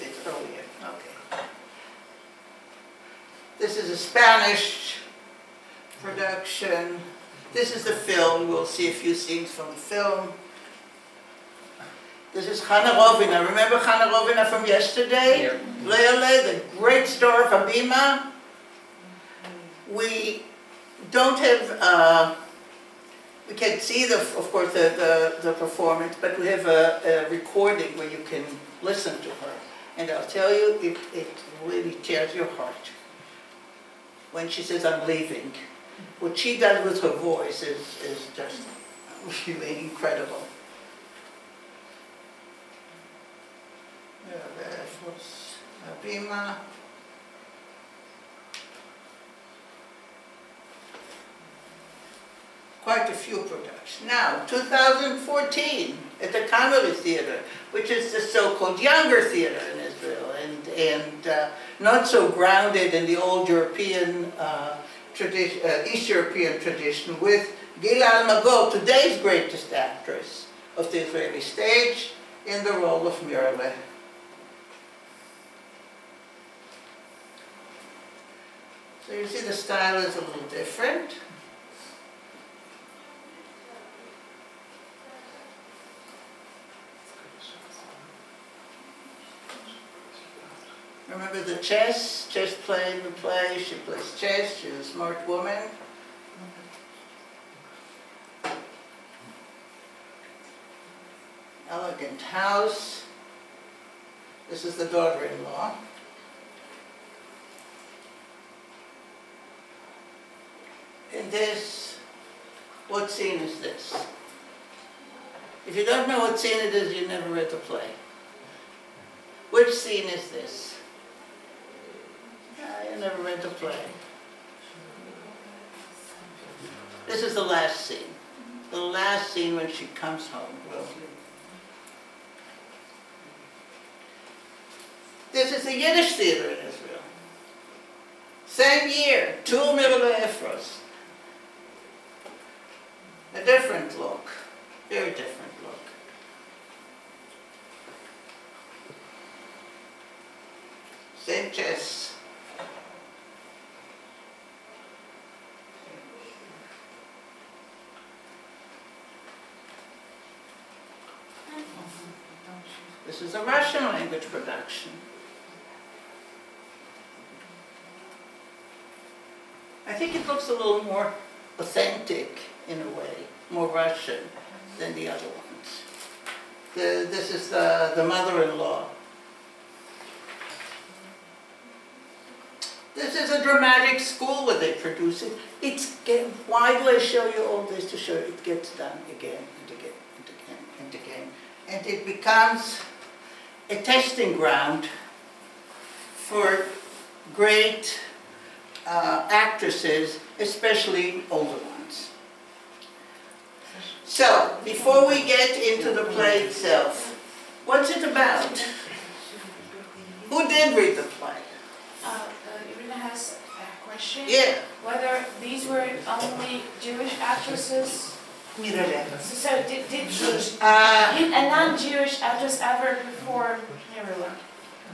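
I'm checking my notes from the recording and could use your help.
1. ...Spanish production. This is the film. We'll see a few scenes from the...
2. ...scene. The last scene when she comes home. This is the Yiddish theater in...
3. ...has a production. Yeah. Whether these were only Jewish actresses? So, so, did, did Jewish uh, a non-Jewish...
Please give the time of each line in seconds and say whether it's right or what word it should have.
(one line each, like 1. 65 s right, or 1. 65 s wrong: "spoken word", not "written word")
1. 3 s right
2. 127 s right
3. 212 s wrong: "question", not "production".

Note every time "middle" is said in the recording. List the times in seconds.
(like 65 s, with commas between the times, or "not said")
139 s.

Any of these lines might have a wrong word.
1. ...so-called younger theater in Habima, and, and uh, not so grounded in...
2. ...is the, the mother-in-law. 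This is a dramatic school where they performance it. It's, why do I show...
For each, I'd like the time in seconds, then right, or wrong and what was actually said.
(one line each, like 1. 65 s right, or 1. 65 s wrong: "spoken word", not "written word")
1. 58 s wrong: "Israel", not "Habima"
2. 177 s wrong: "produce", not "performance".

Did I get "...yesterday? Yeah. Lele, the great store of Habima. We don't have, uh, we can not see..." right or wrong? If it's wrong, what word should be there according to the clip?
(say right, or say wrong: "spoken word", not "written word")
right.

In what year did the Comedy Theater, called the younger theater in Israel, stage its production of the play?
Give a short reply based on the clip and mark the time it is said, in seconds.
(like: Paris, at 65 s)
2014, at 54 s.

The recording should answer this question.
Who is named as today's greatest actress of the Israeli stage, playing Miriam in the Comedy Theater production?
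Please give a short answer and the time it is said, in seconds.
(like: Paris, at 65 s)
Gila Almagor, at 67 s.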